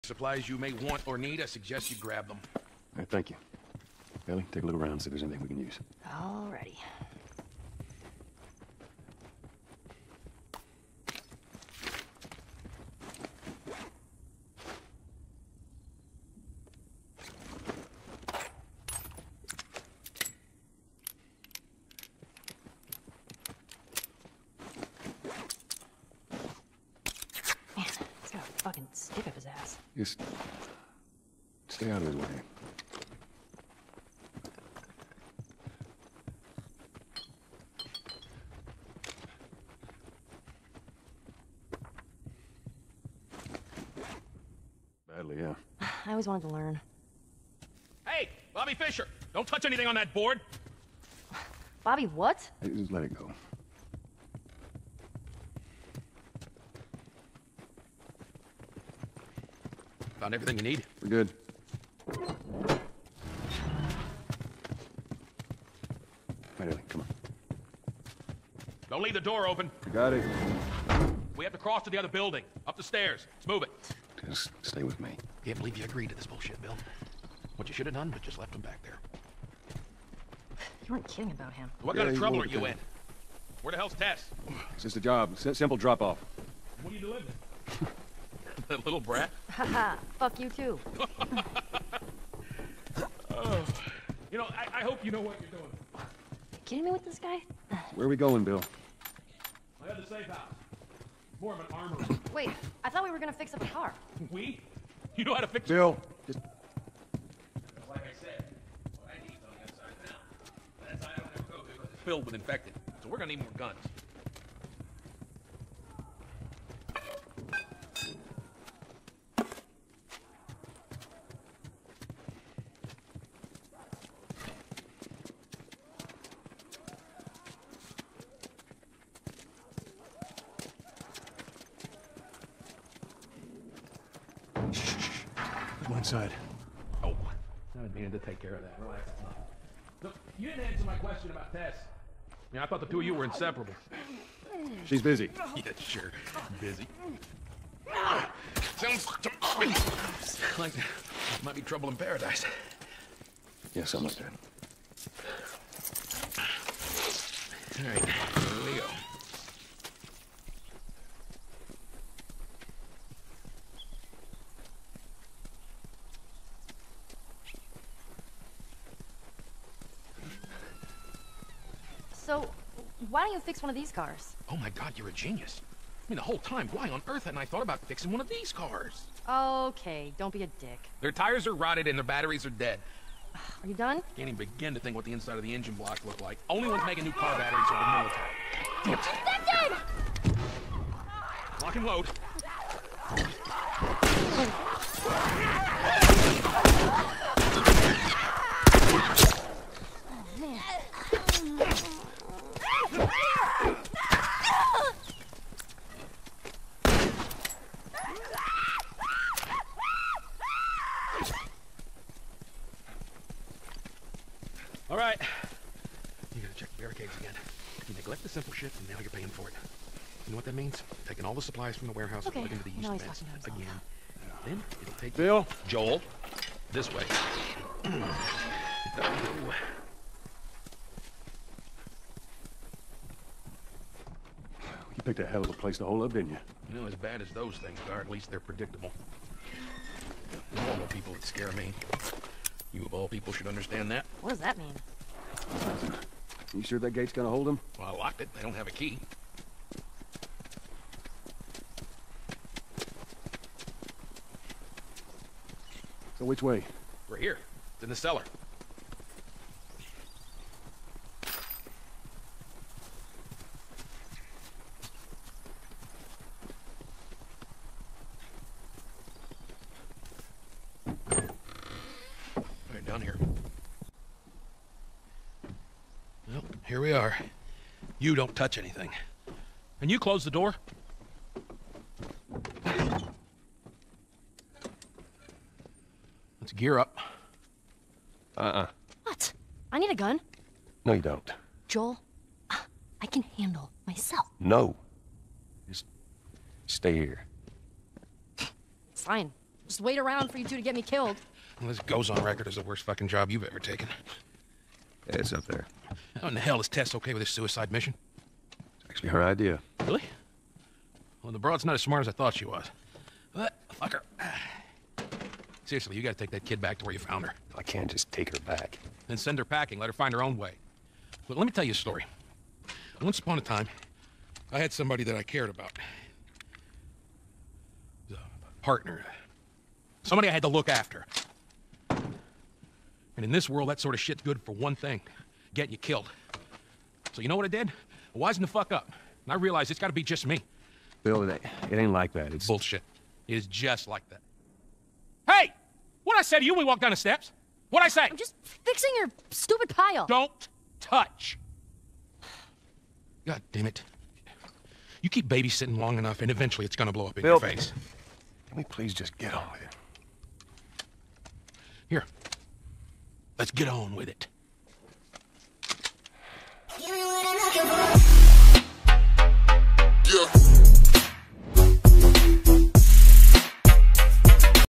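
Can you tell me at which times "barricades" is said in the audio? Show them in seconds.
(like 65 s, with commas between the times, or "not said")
216 s.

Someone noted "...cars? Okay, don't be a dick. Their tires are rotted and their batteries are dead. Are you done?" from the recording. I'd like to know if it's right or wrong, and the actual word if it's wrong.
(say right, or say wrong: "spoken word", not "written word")
right.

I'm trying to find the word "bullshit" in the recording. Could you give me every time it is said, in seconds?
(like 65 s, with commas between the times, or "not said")
76 s, 342 s.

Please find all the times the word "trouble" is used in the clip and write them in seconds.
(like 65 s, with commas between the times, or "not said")
82 s, 151 s.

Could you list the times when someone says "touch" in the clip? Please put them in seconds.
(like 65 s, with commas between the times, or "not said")
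49 s, 278 s, 350 s.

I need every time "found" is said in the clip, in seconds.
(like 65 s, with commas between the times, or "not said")
60 s, 316 s.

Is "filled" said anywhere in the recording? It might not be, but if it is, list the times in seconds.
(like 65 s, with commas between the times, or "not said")
112 s.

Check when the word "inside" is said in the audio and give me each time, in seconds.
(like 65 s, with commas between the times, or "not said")
135 s, 185 s.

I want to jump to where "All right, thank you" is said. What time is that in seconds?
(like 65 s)
2 s.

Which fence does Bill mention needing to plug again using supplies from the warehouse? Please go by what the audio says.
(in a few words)
East fence.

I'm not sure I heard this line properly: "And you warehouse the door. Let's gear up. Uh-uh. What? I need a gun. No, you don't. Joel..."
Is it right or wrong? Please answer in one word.
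wrong.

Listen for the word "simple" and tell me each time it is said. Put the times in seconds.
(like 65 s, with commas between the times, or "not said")
85 s, 218 s.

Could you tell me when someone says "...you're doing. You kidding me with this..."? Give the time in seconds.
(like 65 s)
95 s.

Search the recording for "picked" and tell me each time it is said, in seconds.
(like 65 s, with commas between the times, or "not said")
235 s.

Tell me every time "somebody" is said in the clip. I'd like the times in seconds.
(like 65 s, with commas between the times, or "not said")
324 s, 330 s.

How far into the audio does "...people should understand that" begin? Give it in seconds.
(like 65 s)
243 s.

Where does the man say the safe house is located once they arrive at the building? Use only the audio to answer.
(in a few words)
The cellar.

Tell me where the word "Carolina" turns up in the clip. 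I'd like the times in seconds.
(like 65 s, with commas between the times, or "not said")
not said.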